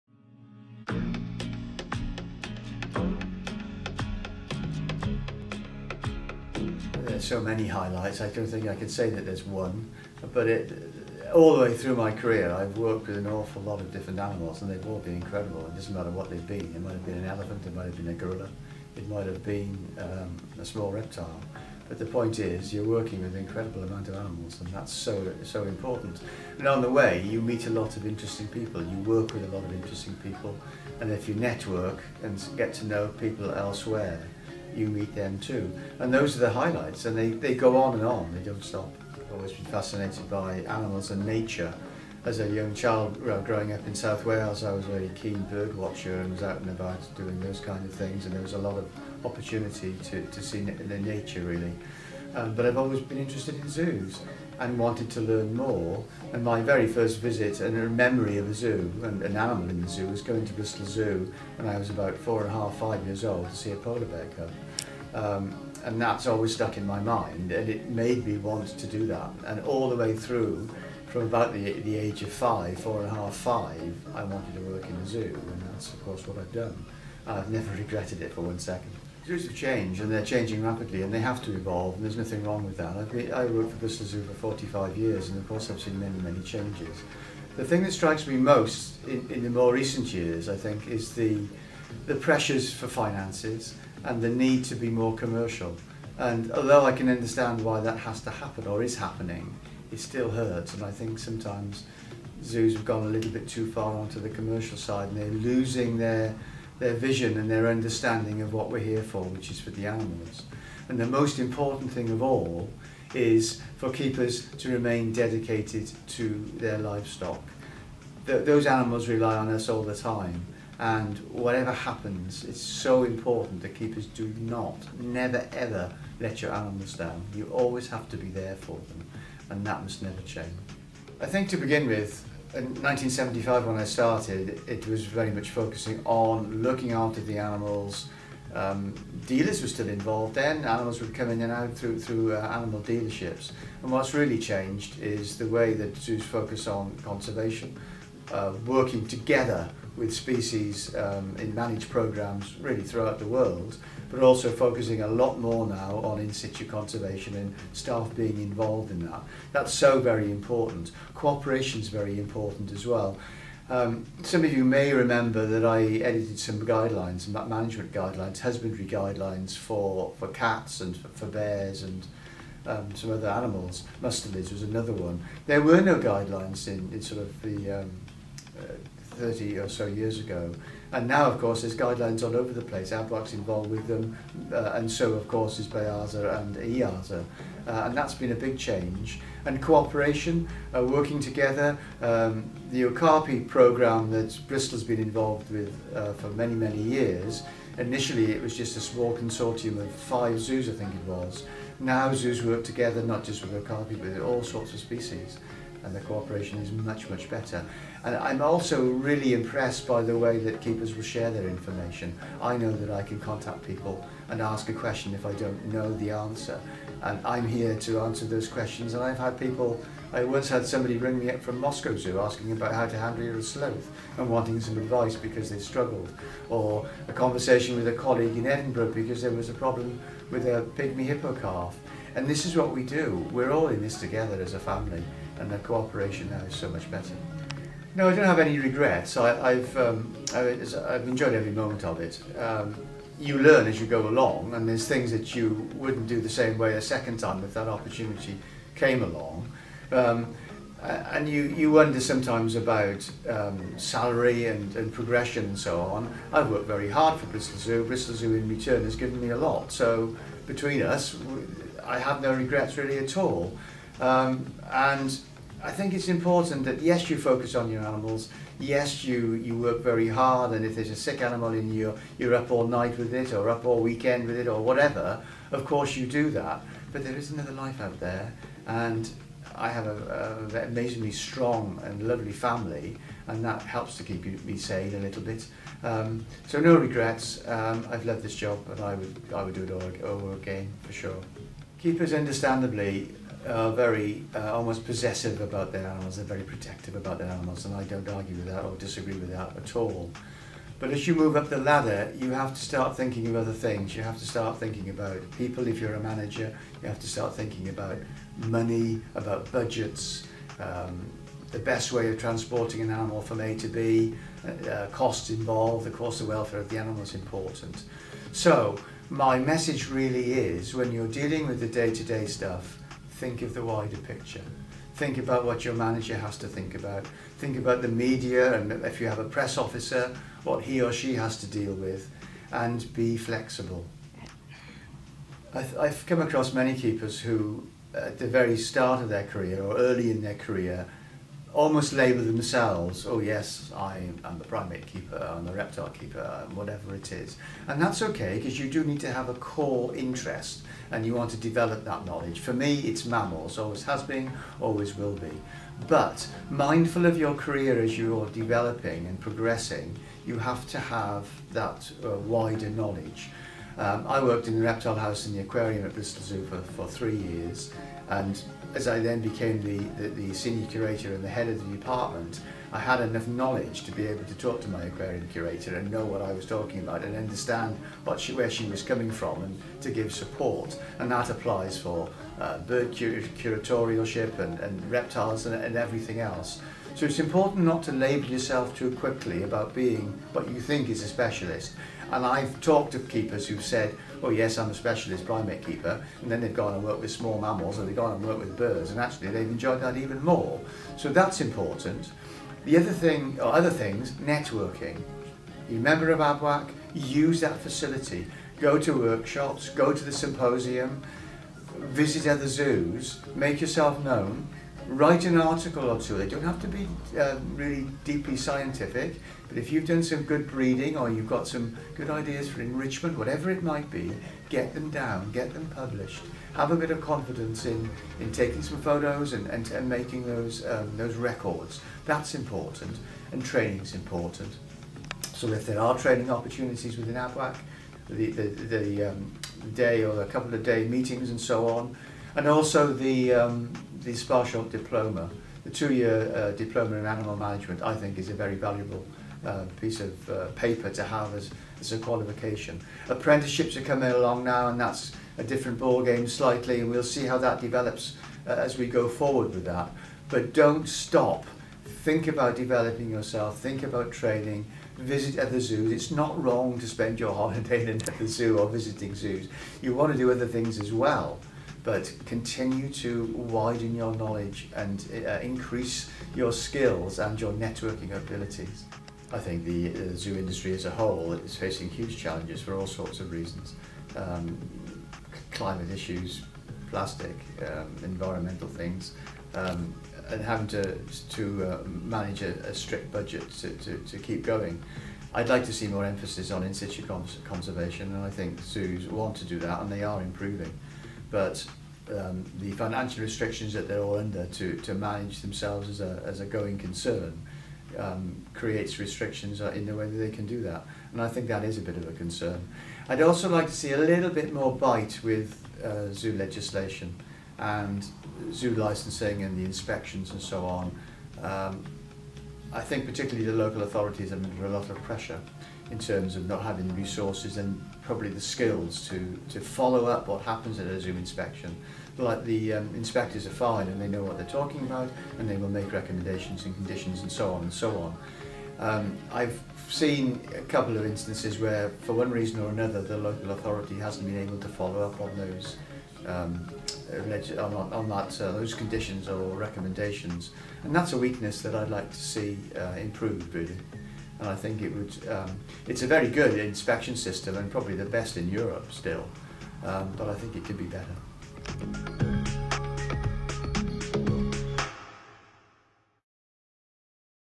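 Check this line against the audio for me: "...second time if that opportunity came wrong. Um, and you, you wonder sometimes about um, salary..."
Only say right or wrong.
wrong.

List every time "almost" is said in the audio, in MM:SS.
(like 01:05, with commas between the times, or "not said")
04:54, 05:41.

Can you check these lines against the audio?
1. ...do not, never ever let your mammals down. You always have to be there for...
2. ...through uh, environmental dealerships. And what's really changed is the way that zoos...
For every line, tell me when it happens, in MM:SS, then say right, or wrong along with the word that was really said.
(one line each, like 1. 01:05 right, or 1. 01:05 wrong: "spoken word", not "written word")
1. 02:04 wrong: "animals", not "mammals"
2. 02:22 wrong: "animal", not "environmental".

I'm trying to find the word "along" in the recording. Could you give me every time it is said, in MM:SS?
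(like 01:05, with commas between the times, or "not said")
04:04, 04:09, 07:34.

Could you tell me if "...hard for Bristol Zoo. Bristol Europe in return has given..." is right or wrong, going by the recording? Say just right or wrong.
wrong.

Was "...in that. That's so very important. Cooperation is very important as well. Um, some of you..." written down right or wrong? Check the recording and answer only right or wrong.
right.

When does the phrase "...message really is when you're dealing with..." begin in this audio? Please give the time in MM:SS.
05:19.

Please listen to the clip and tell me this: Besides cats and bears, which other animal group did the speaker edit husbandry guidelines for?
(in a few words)
Mustelids.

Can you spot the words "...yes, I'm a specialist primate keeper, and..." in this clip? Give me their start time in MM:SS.
06:34.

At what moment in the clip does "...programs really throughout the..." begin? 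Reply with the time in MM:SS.
02:31.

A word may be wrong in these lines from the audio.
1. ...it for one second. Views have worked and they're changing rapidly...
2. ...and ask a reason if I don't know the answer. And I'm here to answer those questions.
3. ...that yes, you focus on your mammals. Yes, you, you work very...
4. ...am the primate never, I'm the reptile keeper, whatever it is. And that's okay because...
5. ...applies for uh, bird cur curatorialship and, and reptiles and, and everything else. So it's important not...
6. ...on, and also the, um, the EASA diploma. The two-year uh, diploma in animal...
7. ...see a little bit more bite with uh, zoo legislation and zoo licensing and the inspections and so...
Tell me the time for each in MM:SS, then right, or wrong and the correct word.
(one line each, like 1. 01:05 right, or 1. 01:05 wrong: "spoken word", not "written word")
1. 01:18 wrong: "changed", not "worked"
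2. 03:34 wrong: "question", not "reason"
3. 04:26 wrong: "animals", not "mammals"
4. 05:44 wrong: "keeper", not "never"
5. 06:21 right
6. 07:21 wrong: "Sparsholt", not "EASA"
7. 08:33 right.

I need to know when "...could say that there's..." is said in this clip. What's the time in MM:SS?
00:08.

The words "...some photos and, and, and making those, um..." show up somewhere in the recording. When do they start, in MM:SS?
07:08.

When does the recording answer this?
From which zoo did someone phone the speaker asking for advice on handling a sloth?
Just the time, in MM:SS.
03:41.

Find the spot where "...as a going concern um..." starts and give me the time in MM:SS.
08:26.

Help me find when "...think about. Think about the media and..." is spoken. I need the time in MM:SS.
05:26.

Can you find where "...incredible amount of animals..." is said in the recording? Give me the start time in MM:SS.
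00:23.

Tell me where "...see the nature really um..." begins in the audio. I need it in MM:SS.
00:50.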